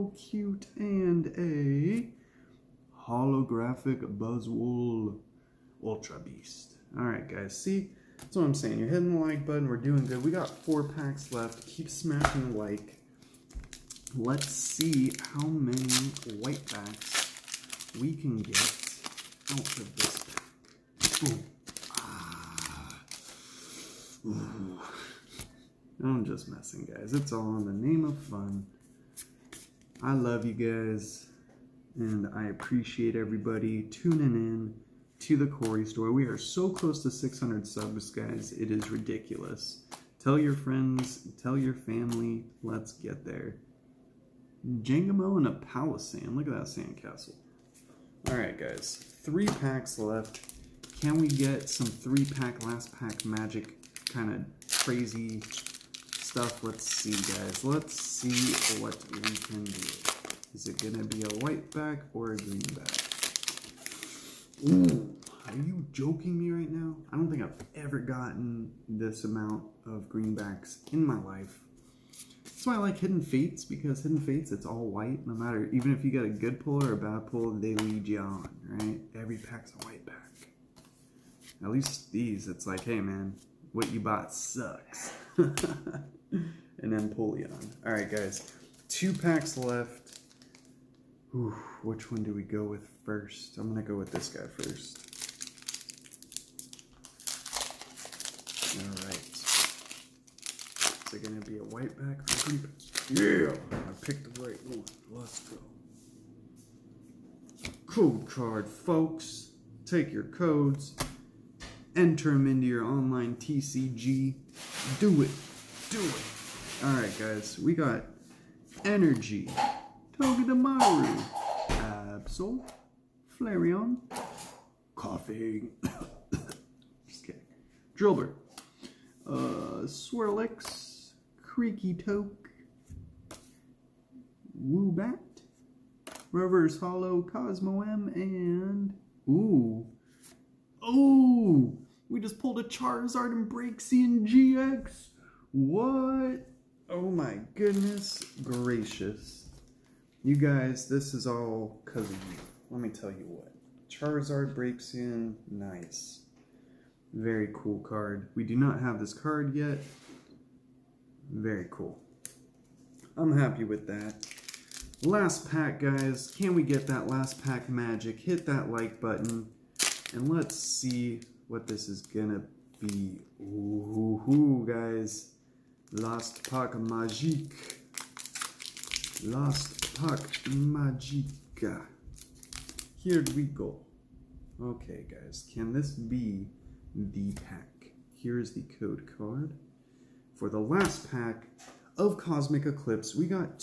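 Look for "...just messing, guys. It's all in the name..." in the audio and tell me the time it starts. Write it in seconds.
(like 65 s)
26 s.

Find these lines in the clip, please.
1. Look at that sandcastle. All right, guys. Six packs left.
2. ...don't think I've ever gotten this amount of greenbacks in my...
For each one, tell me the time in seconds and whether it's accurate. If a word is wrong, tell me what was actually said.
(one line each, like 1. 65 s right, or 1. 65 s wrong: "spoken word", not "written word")
1. 46 s wrong: "Three", not "Six"
2. 67 s right.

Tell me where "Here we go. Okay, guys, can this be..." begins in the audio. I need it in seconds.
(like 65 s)
182 s.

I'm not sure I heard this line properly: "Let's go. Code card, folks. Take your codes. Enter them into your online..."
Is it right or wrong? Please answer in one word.
right.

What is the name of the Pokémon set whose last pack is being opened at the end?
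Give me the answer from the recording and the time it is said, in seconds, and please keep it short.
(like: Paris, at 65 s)
Cosmic Eclipse, at 192 s.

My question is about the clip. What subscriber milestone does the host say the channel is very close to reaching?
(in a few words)
600.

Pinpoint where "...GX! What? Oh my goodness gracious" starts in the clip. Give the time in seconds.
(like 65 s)
144 s.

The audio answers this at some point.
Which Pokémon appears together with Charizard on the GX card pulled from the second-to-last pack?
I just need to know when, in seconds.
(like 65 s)
154 s.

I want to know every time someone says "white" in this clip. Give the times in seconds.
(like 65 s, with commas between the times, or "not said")
16 s, 61 s, 74 s, 79 s, 101 s.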